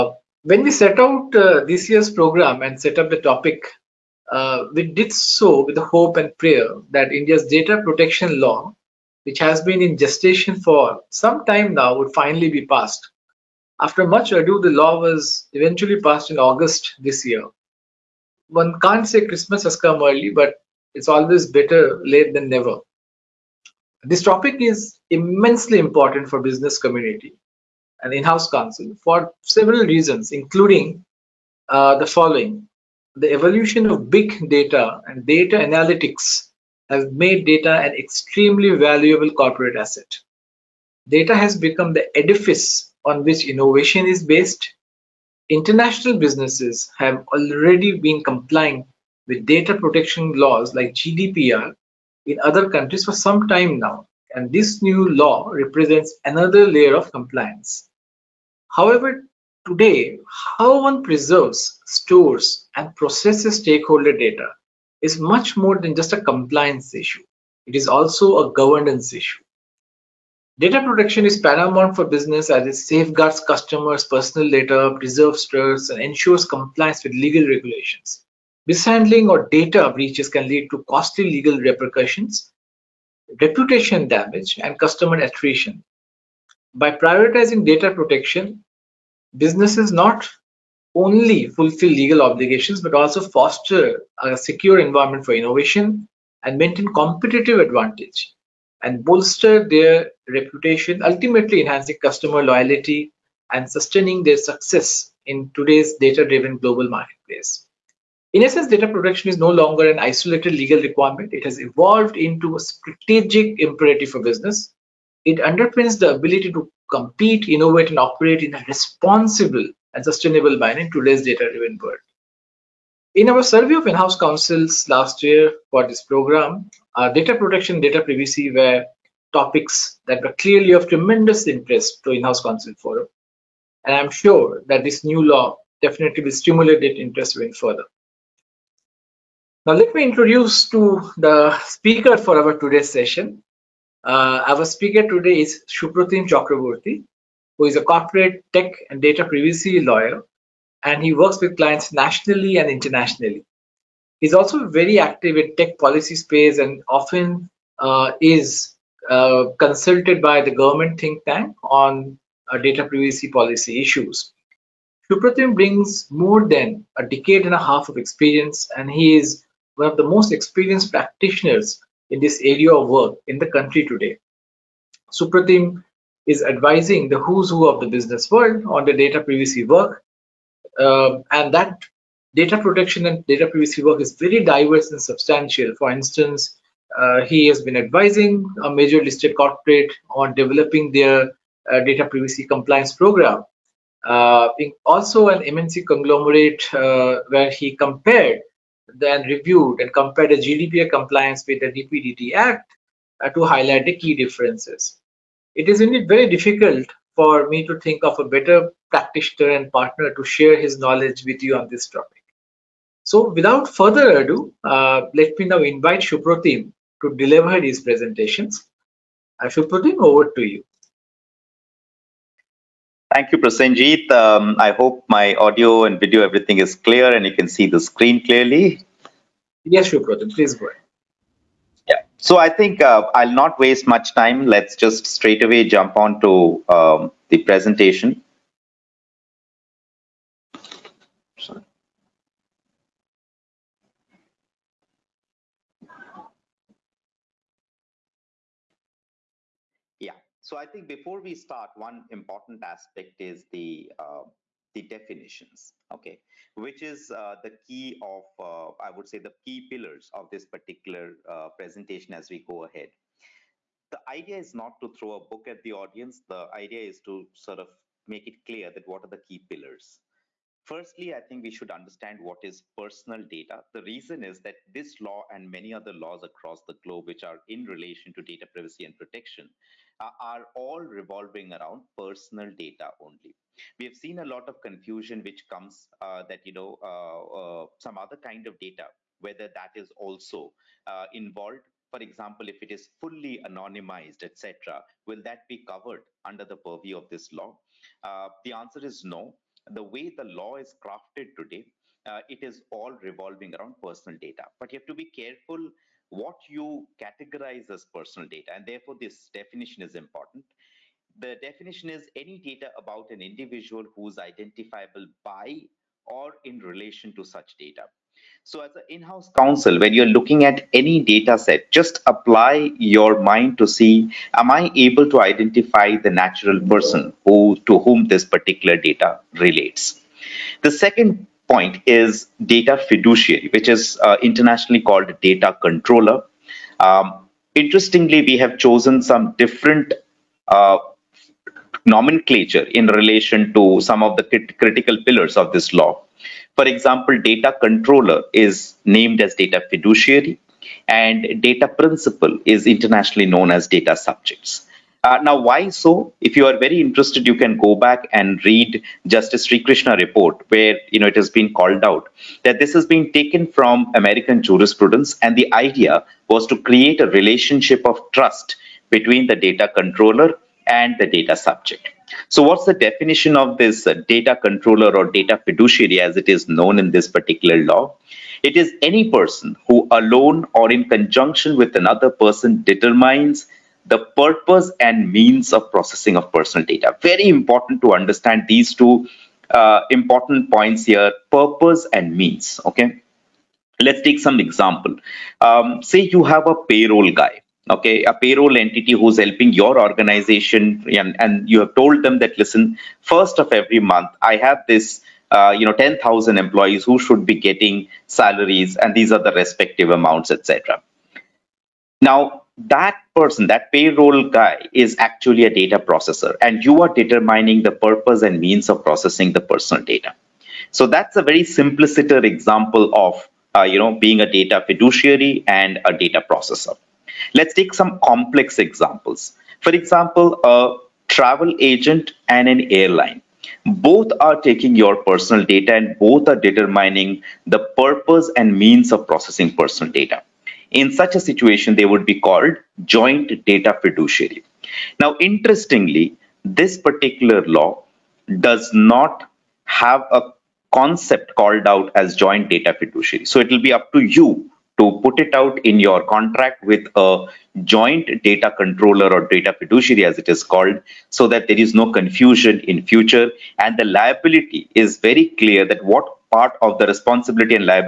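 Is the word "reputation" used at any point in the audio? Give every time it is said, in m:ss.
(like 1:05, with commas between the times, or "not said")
1:23, 1:40.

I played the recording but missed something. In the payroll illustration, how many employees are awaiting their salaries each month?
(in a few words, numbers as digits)
10000.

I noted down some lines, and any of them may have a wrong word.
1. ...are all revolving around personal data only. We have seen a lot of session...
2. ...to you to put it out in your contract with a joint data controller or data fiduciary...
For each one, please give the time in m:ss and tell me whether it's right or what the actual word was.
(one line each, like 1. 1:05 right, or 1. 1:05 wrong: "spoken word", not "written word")
1. 4:40 wrong: "confusion", not "session"
2. 7:33 right.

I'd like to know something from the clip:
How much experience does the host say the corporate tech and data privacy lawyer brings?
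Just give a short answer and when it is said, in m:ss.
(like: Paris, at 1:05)
a decade and a half, at 2:46.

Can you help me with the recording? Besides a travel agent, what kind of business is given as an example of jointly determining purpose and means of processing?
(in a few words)
an airline.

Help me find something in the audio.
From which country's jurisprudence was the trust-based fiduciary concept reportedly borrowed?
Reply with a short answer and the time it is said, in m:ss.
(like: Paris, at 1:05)
American, at 6:03.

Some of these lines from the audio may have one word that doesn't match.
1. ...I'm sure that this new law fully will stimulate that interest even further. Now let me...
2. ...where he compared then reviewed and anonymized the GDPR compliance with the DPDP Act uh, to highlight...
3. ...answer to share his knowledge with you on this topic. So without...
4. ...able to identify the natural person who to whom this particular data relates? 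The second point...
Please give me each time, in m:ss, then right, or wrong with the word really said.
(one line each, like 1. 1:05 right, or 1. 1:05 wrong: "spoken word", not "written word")
1. 2:13 wrong: "definitely", not "fully"
2. 3:17 wrong: "compared", not "anonymized"
3. 3:29 wrong: "partner", not "answer"
4. 5:24 right.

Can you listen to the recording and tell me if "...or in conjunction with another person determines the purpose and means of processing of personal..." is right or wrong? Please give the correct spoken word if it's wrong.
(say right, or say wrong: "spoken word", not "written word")
right.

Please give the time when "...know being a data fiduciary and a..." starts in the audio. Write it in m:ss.
7:03.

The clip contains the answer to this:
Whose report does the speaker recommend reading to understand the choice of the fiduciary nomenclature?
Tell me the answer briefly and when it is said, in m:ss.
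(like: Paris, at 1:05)
Justice Srikrishna, at 5:59.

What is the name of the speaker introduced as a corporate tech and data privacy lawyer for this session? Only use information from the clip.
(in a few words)
Supratim Chakraborty.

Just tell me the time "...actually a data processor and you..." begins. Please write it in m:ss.
6:54.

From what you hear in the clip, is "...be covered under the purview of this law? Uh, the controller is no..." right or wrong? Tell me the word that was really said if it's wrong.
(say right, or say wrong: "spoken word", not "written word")
wrong: "answer", not "controller".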